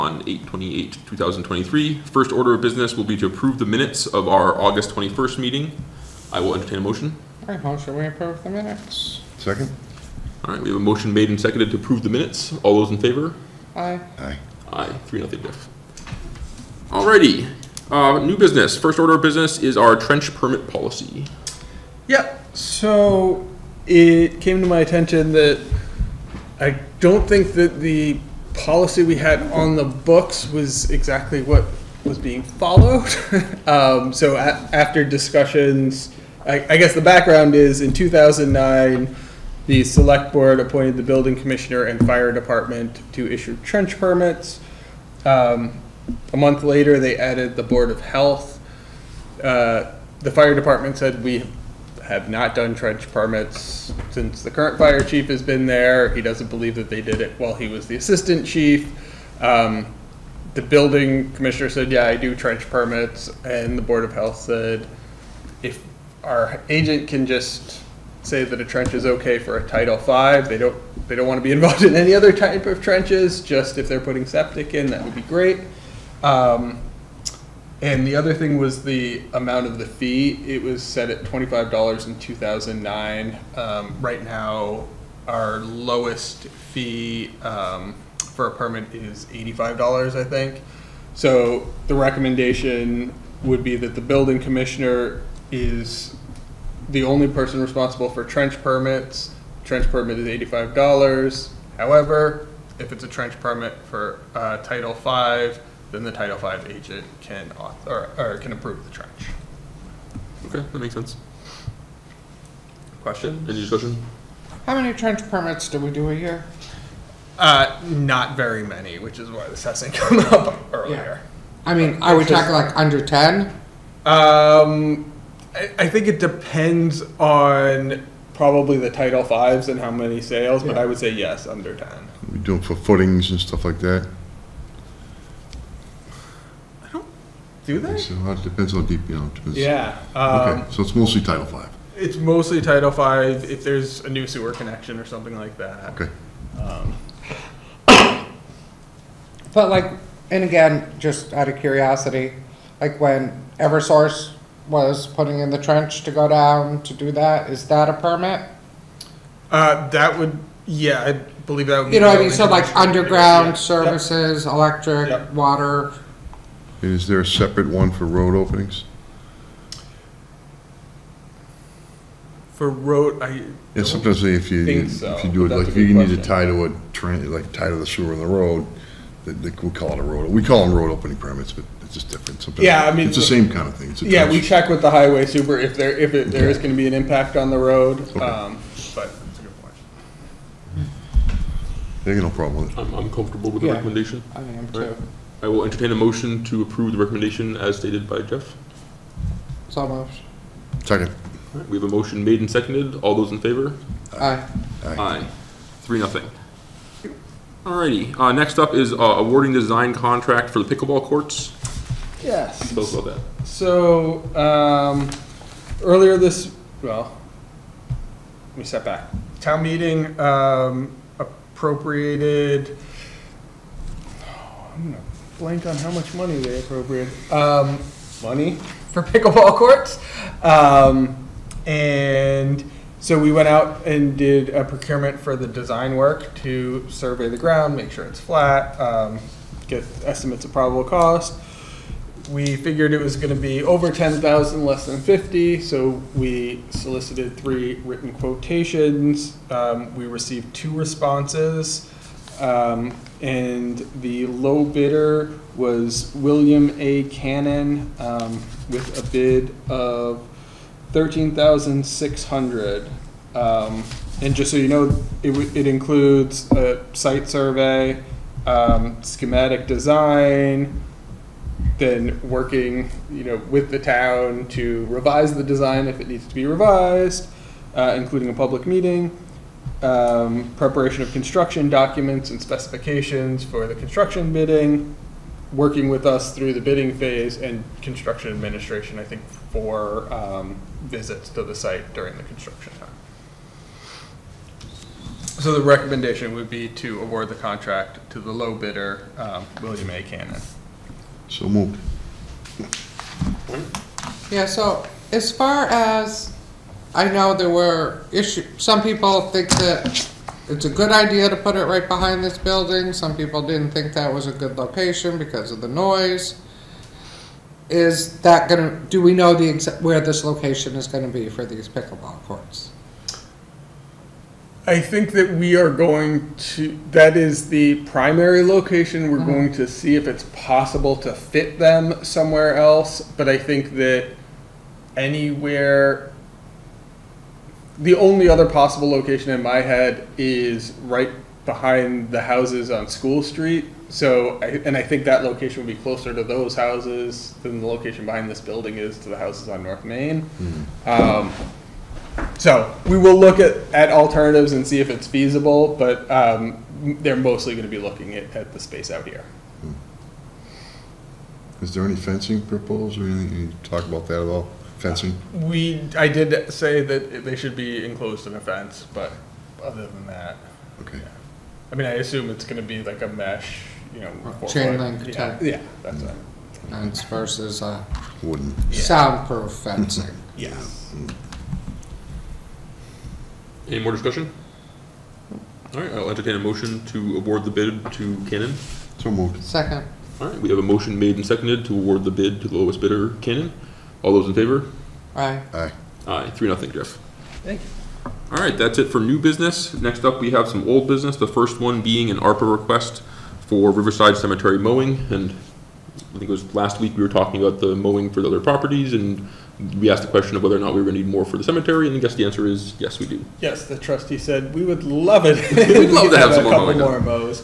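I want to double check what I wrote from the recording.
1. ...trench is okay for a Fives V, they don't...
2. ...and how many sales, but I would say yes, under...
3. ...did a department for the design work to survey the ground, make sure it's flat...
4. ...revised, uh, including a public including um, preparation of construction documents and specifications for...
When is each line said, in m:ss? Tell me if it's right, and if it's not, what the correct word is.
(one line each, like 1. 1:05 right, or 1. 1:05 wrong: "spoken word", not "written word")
1. 1:08 wrong: "Title", not "Fives"
2. 2:09 right
3. 3:54 wrong: "procurement", not "department"
4. 4:36 wrong: "meeting", not "including".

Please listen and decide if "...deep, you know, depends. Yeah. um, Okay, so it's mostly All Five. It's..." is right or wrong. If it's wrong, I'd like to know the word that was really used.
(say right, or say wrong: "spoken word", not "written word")
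wrong: "Title", not "All".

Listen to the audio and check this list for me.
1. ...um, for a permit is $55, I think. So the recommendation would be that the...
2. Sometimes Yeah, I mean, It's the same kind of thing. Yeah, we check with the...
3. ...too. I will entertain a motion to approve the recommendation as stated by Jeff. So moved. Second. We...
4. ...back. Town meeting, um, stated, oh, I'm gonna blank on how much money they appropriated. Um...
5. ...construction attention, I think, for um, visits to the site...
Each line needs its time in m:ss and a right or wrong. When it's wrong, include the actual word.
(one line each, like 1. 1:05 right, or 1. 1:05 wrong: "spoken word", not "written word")
1. 1:27 wrong: "85", not "55"
2. 3:02 right
3. 3:14 right
4. 3:38 wrong: "appropriated", not "stated"
5. 4:47 wrong: "administration", not "attention".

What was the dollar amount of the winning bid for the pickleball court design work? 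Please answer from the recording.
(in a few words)
$13,600.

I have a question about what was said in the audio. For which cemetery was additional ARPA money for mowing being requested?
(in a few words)
Riverside Cemetery.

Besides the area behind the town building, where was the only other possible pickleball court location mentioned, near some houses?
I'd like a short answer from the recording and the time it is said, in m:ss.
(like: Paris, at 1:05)
School Street, at 5:42.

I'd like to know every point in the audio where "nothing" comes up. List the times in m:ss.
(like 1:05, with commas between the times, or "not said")
0:15, 3:25, 6:36.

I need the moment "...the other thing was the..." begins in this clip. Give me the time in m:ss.
1:18.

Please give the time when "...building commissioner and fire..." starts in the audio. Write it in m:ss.
0:41.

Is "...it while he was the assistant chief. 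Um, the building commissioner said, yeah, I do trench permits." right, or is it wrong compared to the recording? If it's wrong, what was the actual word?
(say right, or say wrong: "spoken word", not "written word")
right.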